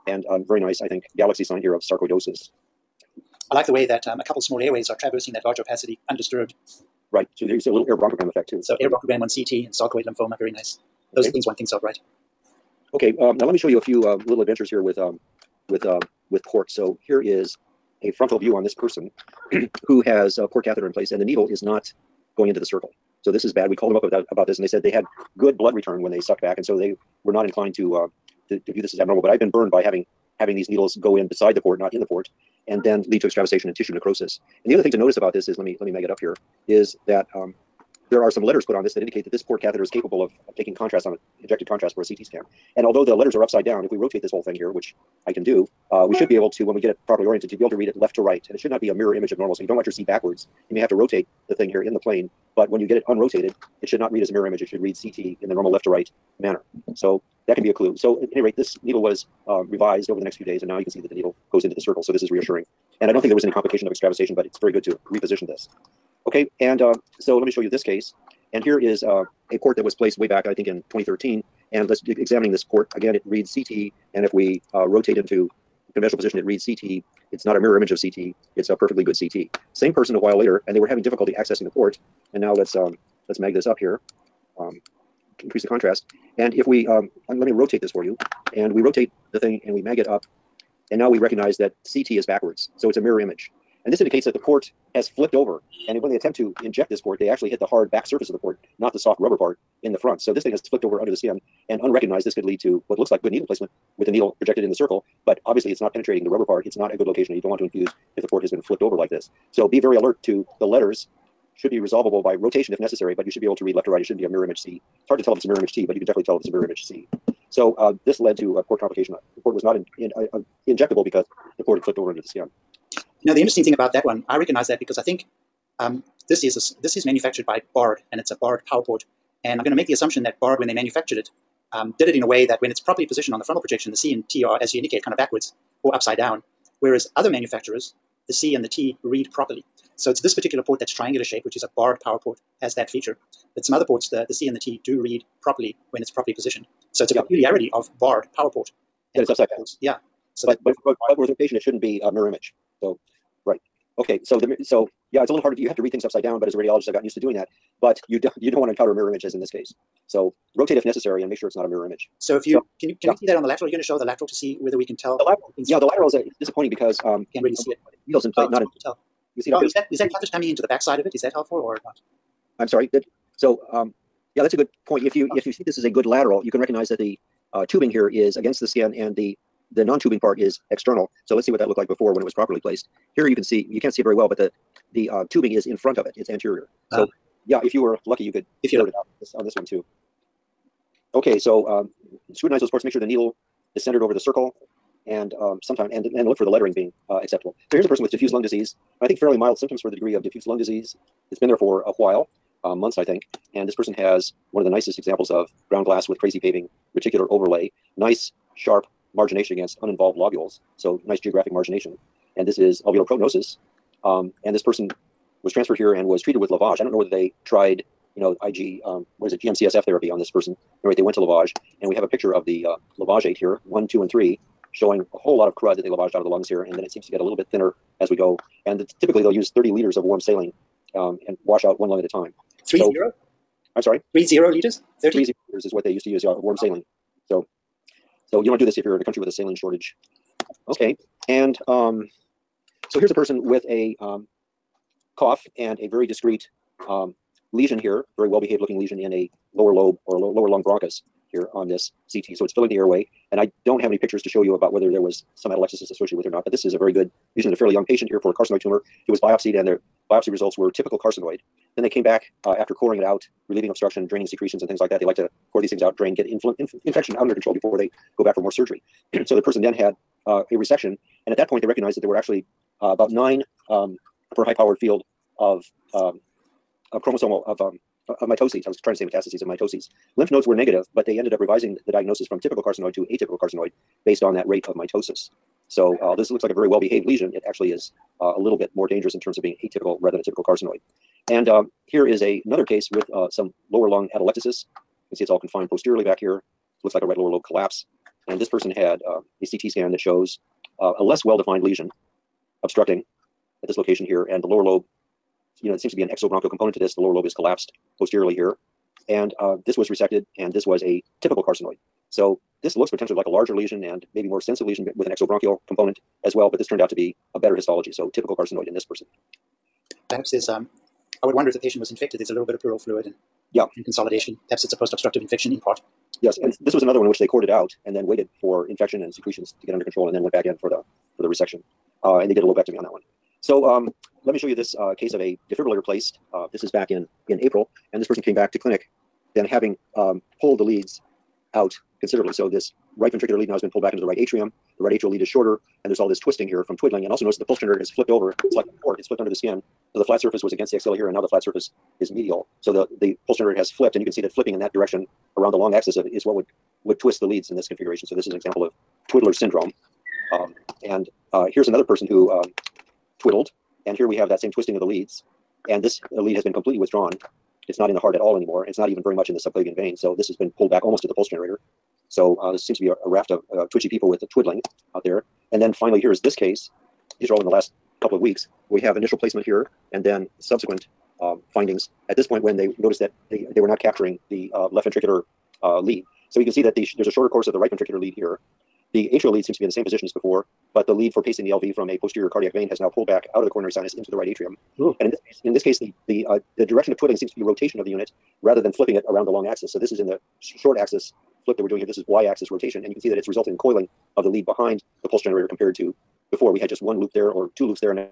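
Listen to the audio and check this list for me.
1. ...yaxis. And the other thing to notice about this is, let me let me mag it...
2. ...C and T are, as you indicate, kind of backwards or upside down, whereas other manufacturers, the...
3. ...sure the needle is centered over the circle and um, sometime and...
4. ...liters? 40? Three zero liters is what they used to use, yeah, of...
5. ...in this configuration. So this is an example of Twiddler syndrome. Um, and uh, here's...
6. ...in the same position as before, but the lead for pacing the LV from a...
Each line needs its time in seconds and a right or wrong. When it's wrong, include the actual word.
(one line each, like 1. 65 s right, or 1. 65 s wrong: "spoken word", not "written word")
1. 33 s wrong: "necrosis", not "yaxis"
2. 133 s right
3. 192 s right
4. 234 s wrong: "30", not "40"
5. 357 s right
6. 389 s right.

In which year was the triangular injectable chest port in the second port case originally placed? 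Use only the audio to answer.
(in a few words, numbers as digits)
2013.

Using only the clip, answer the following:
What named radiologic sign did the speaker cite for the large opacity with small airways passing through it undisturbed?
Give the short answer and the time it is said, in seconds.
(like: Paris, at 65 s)
galaxy sign, at 1 s.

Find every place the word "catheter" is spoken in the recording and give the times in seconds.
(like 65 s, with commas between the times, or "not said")
20 s, 39 s, 170 s.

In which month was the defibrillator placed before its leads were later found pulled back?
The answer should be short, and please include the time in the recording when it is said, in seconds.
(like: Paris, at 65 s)
April, at 337 s.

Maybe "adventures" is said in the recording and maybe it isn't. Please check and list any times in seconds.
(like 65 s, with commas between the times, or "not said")
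14 s.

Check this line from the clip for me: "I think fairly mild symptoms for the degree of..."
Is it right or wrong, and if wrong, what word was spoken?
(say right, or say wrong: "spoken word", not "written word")
right.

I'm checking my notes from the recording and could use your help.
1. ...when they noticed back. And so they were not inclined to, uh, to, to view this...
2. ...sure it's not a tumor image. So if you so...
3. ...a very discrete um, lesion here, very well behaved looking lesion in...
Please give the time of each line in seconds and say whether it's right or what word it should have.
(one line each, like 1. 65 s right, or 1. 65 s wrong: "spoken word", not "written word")
1. 26 s wrong: "sucked", not "noticed"
2. 161 s wrong: "mirror", not "tumor"
3. 245 s right.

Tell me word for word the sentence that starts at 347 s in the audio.
And also notice that the pulse generator has flipped over.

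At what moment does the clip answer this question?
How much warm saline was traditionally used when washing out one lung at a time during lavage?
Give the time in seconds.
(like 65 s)
229 s.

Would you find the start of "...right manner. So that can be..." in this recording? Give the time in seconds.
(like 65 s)
55 s.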